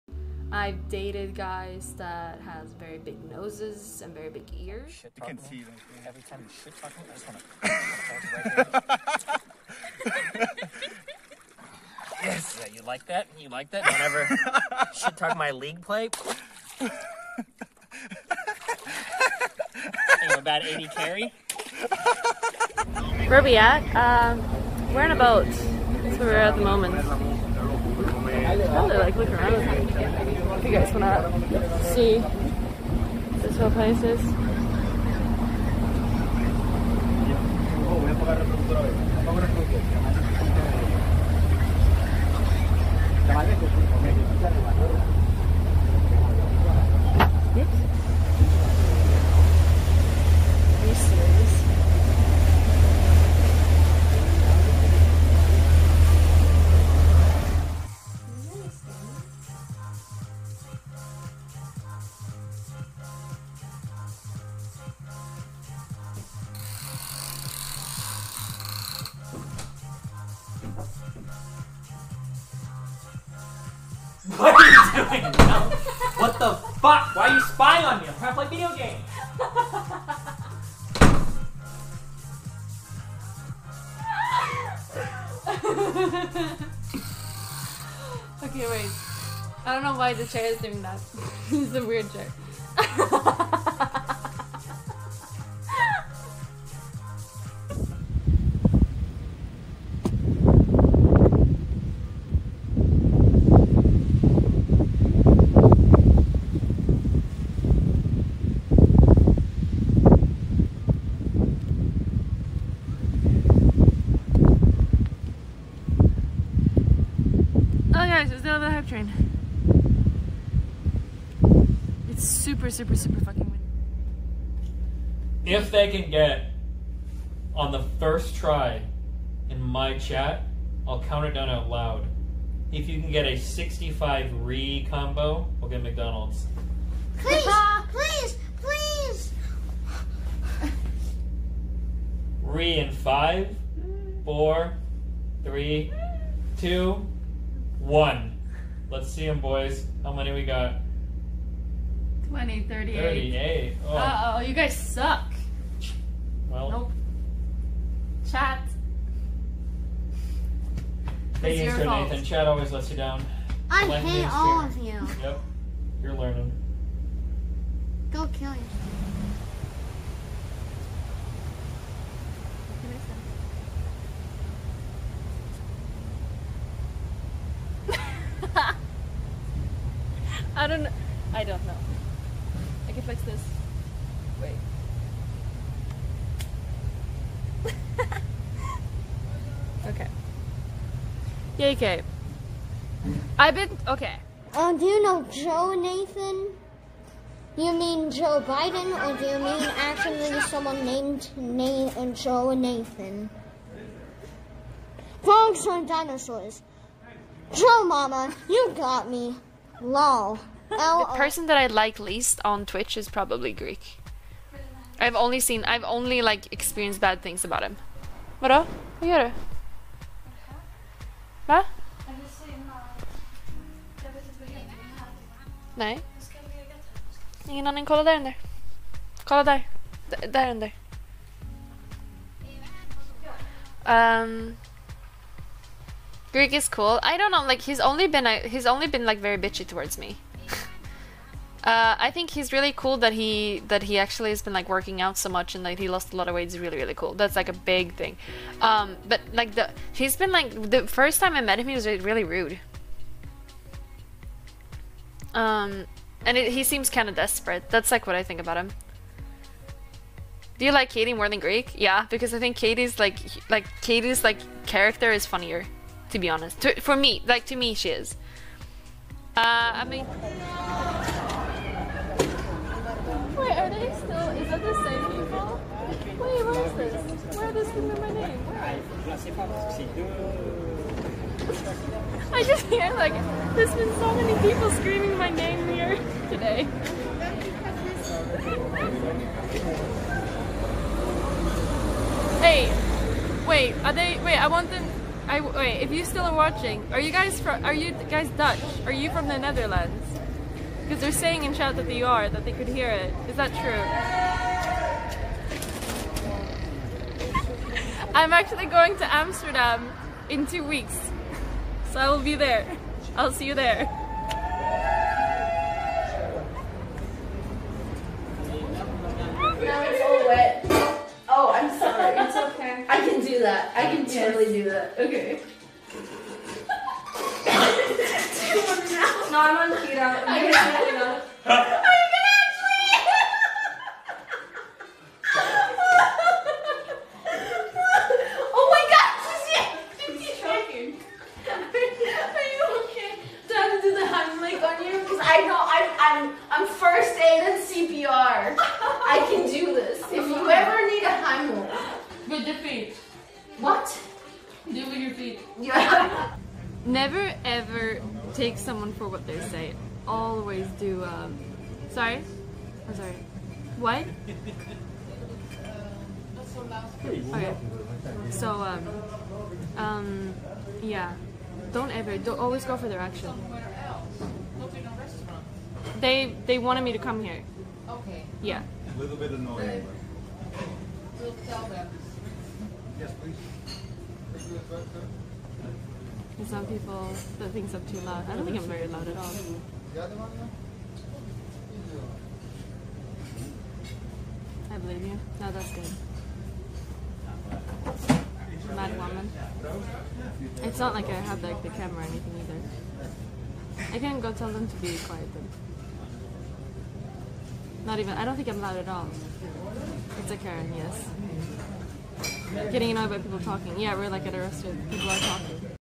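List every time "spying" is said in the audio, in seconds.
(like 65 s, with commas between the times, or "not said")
77 s.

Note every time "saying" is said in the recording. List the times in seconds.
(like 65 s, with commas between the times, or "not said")
301 s.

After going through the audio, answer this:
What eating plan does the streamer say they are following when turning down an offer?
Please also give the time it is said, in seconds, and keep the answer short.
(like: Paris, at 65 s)
keto, at 329 s.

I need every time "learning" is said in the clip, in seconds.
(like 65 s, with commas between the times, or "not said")
166 s.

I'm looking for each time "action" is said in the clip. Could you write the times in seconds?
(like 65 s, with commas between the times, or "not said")
372 s.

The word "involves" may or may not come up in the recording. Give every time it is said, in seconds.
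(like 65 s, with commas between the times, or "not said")
not said.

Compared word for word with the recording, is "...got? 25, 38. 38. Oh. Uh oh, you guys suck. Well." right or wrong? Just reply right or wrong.
wrong.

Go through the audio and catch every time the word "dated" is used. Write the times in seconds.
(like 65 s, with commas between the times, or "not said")
0 s.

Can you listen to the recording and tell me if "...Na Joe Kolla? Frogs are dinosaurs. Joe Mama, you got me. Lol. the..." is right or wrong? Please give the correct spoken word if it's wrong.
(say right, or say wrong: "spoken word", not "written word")
wrong: "Nathan", not "Kolla".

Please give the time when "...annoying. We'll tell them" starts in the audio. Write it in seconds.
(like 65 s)
379 s.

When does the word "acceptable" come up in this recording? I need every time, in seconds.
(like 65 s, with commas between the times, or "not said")
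not said.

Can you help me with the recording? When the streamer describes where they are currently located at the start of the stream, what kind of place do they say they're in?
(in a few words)
a boat.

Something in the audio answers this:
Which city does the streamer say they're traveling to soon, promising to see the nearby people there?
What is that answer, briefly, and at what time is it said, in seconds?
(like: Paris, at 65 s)
Amsterdam, at 309 s.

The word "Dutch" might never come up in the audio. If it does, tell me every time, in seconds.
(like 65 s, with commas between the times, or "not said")
298 s.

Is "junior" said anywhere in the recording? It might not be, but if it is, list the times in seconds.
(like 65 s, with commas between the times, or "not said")
not said.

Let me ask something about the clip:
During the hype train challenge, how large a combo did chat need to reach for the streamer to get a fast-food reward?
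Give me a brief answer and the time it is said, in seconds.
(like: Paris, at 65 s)
65, at 133 s.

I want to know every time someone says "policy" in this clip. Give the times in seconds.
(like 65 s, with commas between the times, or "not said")
not said.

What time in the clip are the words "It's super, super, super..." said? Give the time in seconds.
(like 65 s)
122 s.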